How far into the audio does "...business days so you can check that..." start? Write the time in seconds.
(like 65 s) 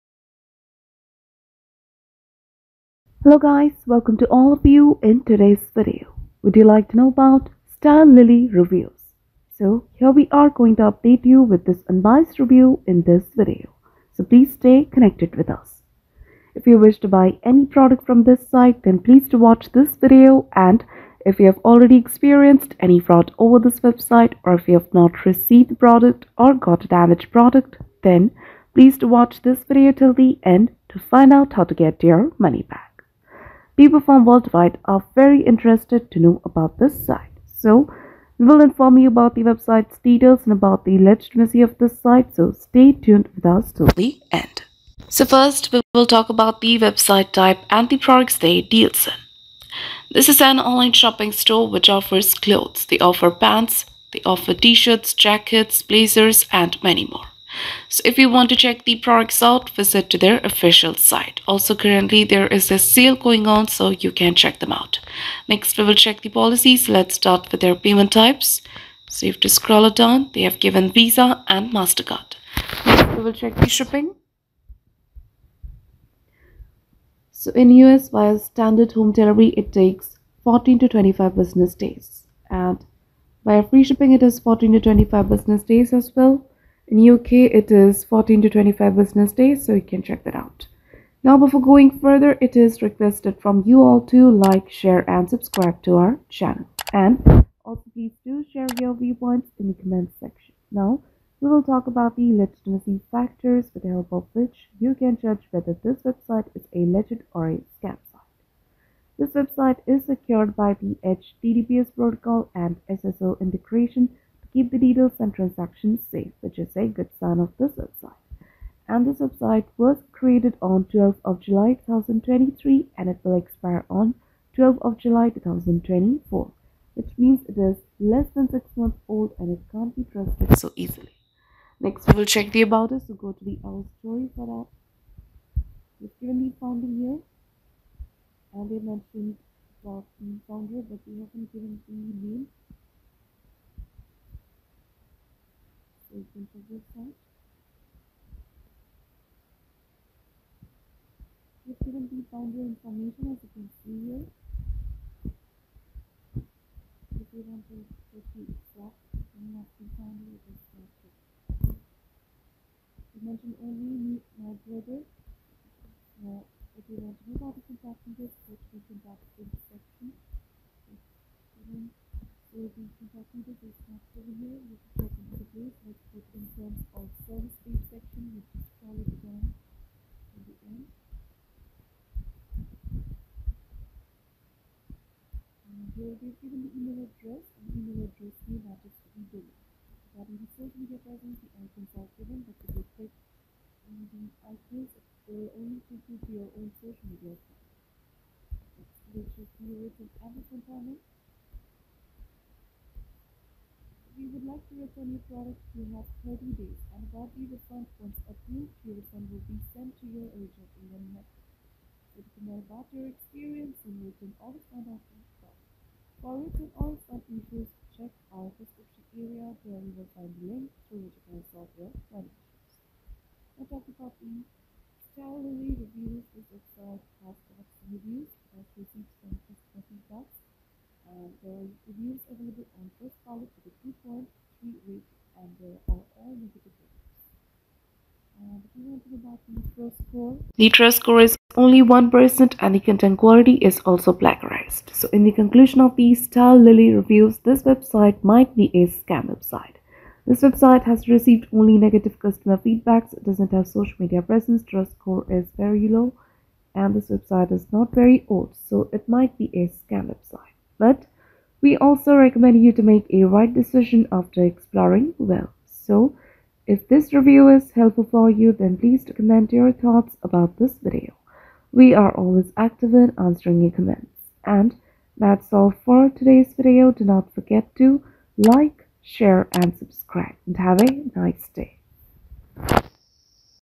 88 s.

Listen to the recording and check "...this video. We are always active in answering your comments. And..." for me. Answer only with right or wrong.
right.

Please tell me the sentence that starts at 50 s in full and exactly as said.
This is an online shopping store which offers clothes.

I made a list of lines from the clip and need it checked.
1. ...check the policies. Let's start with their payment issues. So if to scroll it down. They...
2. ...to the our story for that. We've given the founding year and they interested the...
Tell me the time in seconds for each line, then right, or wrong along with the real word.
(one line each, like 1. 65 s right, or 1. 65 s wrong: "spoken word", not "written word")
1. 65 s wrong: "types", not "issues"
2. 133 s wrong: "mentioned", not "interested".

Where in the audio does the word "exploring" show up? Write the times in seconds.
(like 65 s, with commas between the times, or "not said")
264 s.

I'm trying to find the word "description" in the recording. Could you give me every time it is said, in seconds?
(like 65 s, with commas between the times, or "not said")
218 s.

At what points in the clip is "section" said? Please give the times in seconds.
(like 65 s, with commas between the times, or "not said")
100 s, 169 s, 177 s.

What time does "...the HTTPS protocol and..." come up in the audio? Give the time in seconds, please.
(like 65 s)
110 s.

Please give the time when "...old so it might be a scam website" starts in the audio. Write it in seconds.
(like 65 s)
258 s.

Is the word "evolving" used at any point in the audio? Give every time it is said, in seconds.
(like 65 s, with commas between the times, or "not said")
not said.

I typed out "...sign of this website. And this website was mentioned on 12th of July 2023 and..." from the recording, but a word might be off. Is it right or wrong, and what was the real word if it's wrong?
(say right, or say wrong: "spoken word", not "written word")
wrong: "created", not "mentioned".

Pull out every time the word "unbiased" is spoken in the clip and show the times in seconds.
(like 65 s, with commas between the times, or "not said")
11 s.